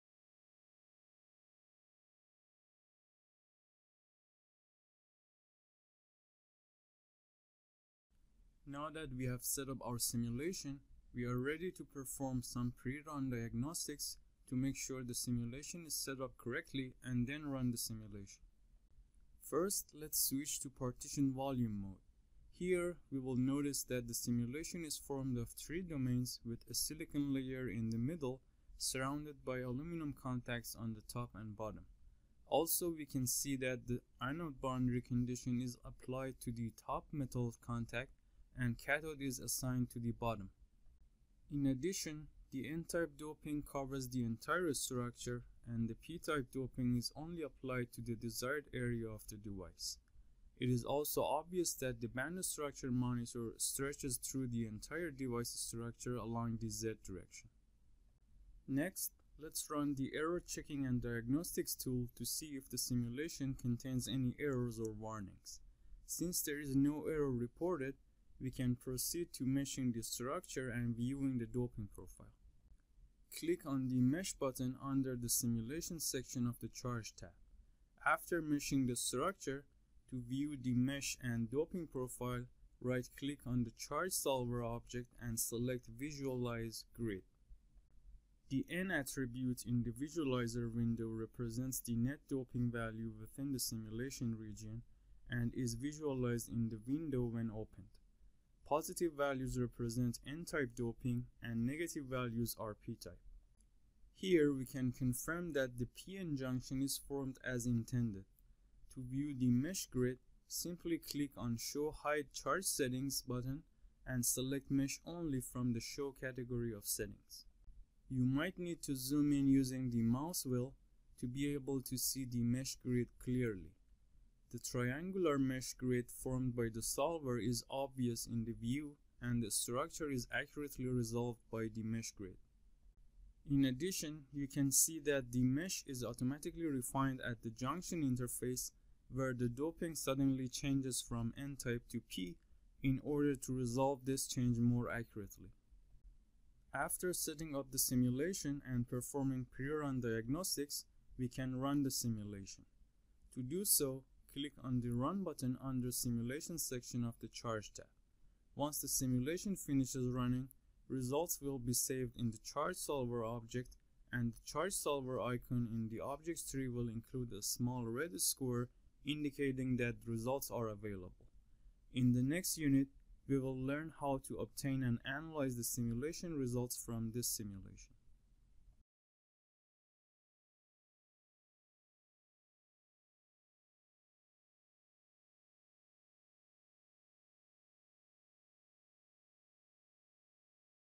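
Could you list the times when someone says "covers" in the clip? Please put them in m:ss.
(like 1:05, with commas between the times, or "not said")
0:43.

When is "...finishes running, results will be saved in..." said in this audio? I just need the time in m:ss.
2:39.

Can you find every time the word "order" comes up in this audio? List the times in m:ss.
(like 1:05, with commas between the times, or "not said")
2:23.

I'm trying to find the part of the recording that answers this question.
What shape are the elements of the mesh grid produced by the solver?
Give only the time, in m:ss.
2:04.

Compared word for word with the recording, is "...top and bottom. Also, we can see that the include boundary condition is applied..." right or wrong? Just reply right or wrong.
wrong.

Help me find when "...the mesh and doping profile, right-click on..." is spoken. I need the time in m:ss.
1:20.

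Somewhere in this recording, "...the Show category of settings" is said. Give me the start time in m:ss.
1:55.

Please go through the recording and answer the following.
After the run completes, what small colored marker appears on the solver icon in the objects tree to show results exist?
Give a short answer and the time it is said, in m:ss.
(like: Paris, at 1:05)
Red square, at 2:47.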